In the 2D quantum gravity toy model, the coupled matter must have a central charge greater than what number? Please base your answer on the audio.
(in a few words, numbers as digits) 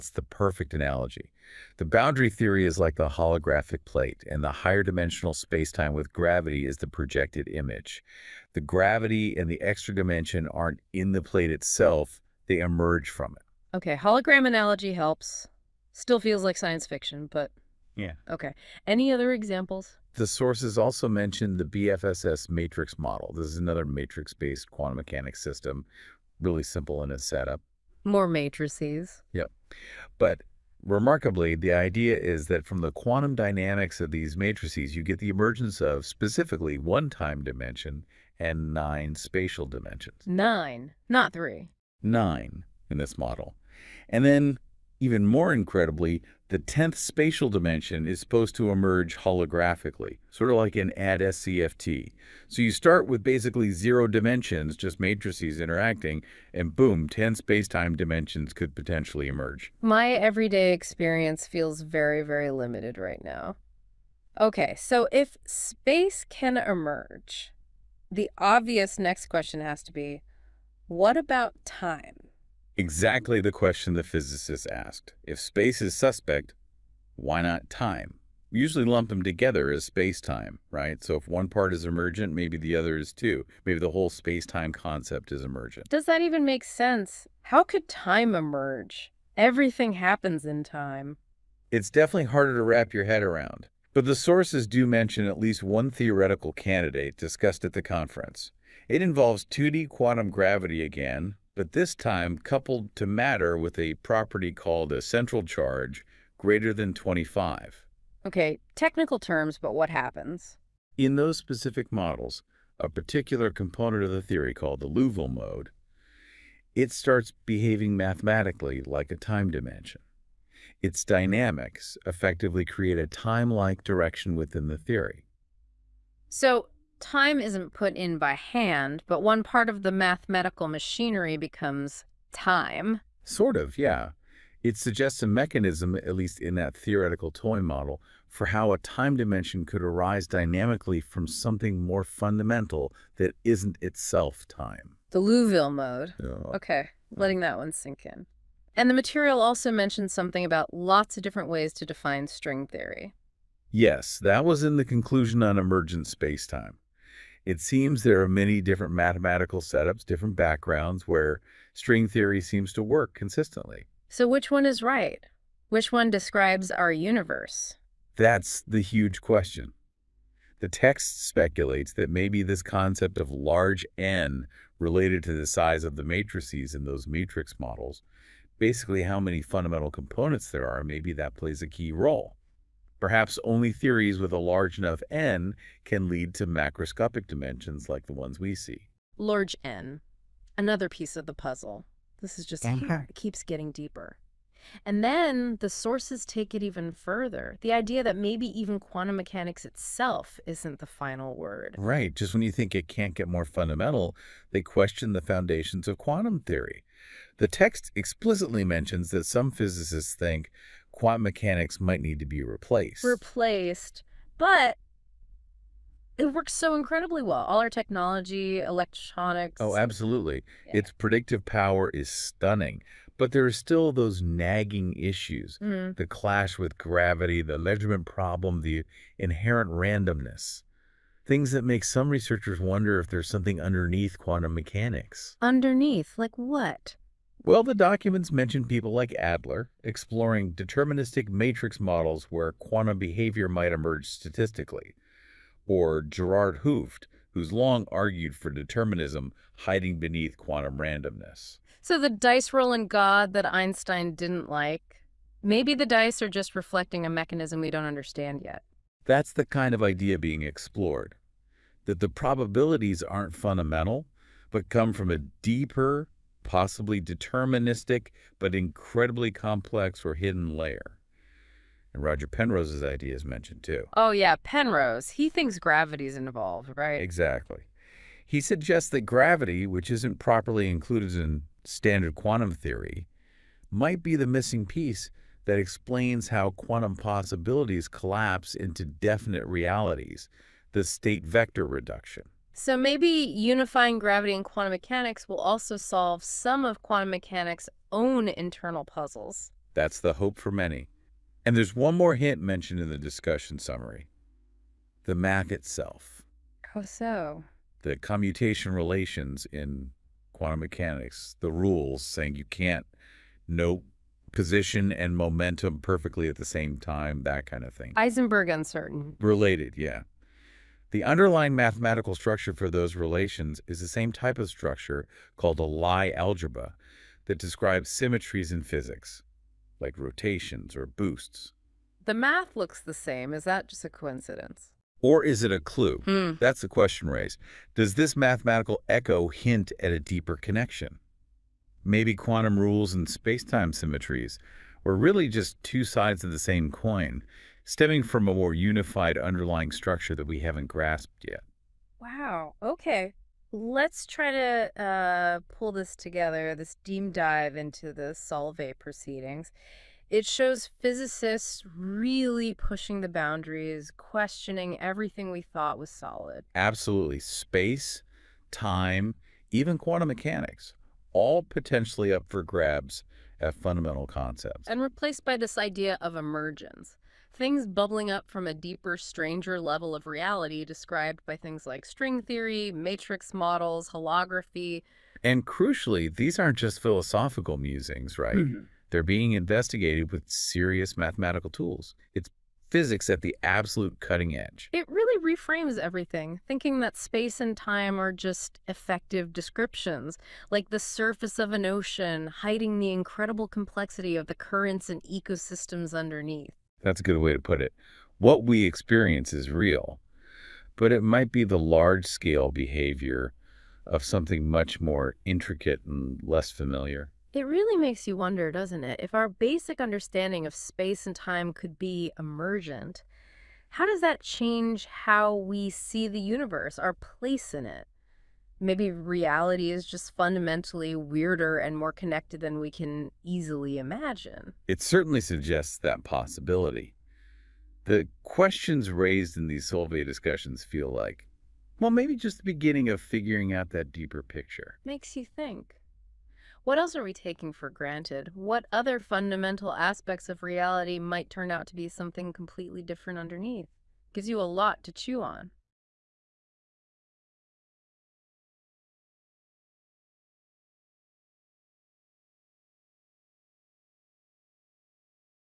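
25.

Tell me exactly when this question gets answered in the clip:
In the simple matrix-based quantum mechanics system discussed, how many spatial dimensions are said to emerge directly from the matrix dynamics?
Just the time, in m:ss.
0:38.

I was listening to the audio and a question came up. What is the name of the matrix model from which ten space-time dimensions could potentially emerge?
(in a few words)
BFSS matrix model.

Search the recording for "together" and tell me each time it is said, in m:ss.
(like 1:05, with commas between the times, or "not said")
1:19, 5:55.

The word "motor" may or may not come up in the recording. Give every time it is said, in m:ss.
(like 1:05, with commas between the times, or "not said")
not said.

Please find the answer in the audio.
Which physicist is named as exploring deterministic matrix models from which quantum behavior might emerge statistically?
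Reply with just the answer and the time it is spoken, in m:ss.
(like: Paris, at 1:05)
Adler, at 3:59.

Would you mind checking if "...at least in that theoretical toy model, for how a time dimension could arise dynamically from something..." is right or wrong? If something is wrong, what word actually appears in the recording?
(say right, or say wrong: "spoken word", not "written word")
right.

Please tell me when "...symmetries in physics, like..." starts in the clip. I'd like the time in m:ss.
5:27.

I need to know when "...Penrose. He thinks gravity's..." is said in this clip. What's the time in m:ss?
4:34.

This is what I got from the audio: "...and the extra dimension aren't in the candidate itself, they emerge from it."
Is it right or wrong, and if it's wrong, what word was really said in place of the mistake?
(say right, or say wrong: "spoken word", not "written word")
wrong: "plate", not "candidate".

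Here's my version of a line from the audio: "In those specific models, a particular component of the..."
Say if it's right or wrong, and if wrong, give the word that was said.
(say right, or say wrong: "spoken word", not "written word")
right.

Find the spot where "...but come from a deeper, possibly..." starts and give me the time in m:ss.
4:24.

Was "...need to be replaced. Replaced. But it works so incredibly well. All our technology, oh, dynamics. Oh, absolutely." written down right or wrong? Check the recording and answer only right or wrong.
wrong.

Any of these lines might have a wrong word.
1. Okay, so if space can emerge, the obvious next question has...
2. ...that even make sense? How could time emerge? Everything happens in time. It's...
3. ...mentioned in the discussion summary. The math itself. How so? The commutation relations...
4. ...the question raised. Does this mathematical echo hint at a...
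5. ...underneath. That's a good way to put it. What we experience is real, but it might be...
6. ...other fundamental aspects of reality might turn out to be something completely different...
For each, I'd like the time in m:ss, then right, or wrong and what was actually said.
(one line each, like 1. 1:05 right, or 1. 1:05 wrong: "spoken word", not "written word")
1. 1:04 right
2. 1:26 right
3. 5:02 right
4. 5:36 right
5. 6:45 right
6. 7:28 right.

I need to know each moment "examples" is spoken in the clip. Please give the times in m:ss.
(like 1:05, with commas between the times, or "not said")
0:19.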